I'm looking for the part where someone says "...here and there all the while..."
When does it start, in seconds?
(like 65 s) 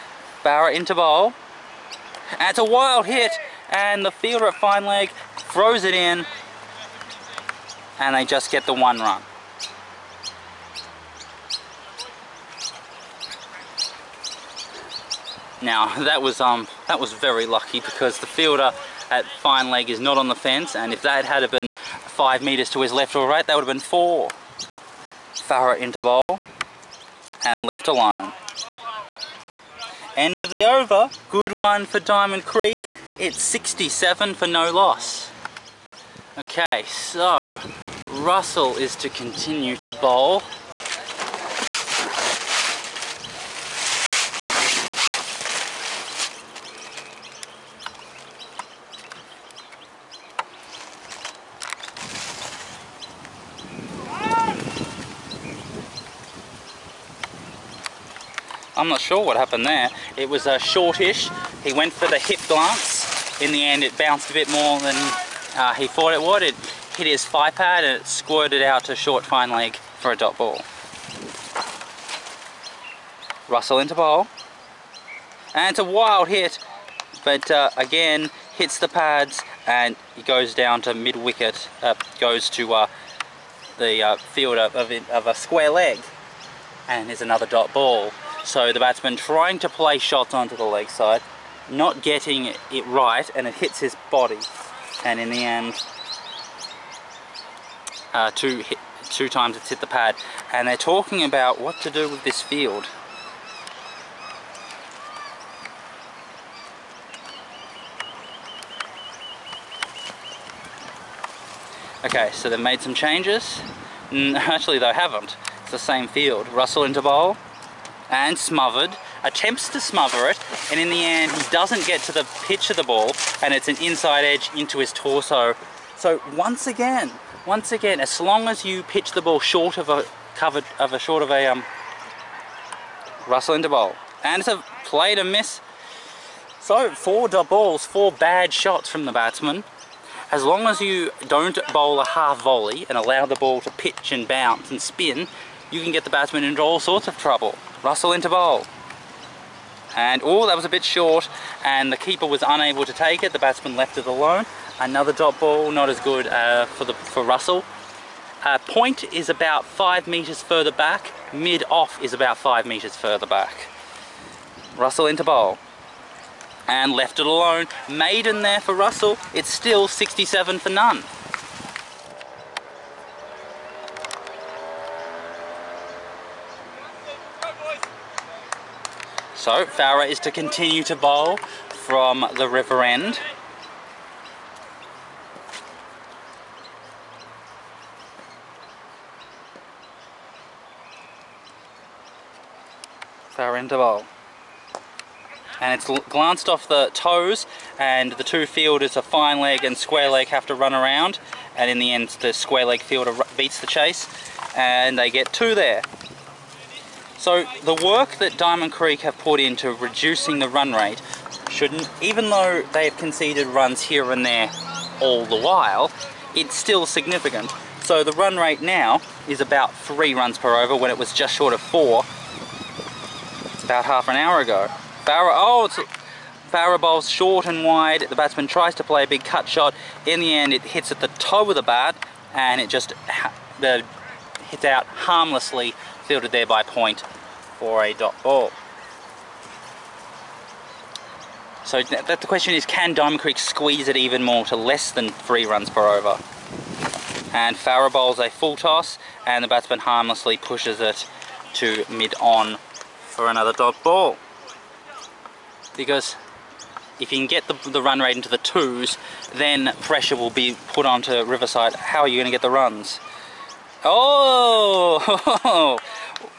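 213 s.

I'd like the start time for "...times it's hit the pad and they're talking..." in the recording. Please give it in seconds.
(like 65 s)
99 s.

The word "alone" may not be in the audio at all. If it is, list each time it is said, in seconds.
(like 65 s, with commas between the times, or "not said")
27 s, 154 s, 167 s.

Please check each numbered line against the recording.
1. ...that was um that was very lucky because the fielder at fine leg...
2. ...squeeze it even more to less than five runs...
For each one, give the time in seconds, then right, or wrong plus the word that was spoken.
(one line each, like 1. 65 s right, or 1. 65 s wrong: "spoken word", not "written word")
1. 16 s right
2. 243 s wrong: "three", not "five".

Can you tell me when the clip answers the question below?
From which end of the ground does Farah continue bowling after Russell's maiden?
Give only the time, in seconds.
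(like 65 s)
182 s.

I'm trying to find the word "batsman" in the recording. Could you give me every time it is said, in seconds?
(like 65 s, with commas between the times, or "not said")
88 s, 139 s, 146 s, 153 s, 228 s, 249 s.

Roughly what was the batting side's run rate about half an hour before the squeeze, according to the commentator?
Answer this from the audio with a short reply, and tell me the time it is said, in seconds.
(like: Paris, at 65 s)
Just short of 4, at 221 s.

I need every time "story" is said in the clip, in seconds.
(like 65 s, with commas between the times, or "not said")
not said.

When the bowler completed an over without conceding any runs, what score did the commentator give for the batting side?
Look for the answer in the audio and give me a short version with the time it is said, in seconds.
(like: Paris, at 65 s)
67 for none, at 169 s.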